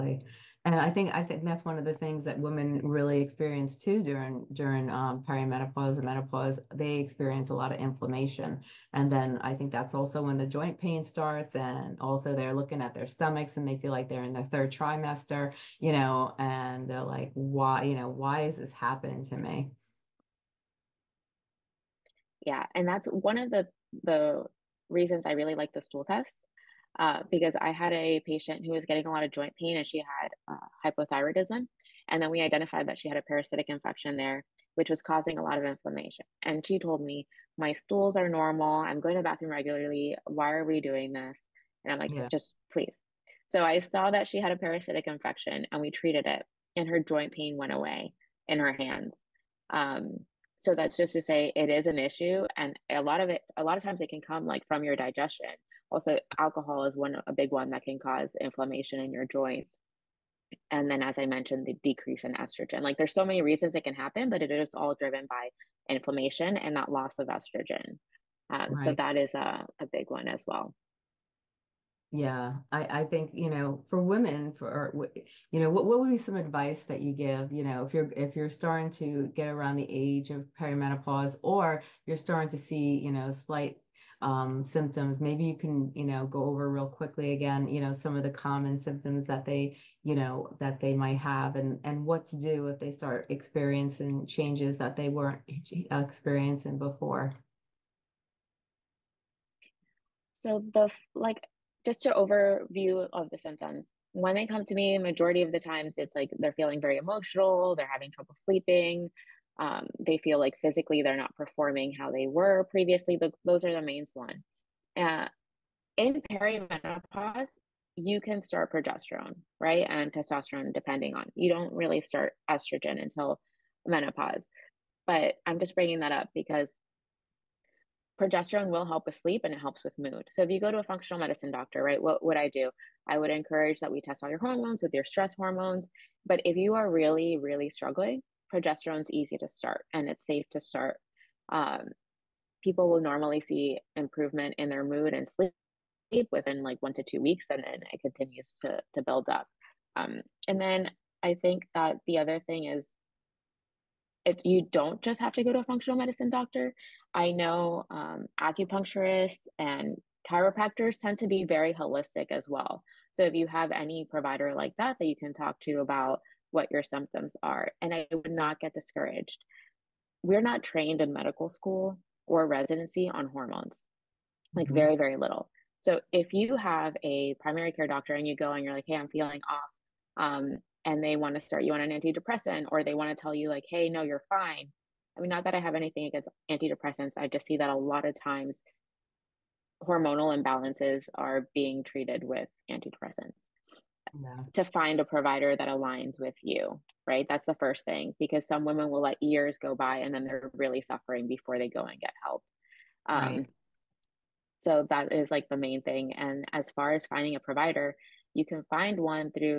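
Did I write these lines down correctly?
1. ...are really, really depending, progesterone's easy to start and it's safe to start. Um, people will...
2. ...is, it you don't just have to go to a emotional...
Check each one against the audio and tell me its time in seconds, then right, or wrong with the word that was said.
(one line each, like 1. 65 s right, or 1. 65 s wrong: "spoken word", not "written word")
1. 136 s wrong: "struggling", not "depending"
2. 152 s wrong: "functional", not "emotional".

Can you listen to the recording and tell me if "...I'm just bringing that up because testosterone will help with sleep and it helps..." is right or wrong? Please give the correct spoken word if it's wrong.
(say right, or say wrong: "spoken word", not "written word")
wrong: "progesterone", not "testosterone".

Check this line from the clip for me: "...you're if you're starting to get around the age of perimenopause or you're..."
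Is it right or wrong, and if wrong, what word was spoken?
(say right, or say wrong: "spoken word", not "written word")
right.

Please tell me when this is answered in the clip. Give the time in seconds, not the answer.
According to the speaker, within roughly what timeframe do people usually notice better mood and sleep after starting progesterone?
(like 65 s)
146 s.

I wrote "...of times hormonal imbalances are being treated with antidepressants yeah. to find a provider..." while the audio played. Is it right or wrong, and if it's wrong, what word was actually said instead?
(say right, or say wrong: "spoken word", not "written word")
right.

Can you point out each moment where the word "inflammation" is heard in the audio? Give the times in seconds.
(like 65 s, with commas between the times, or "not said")
7 s, 35 s, 58 s, 65 s.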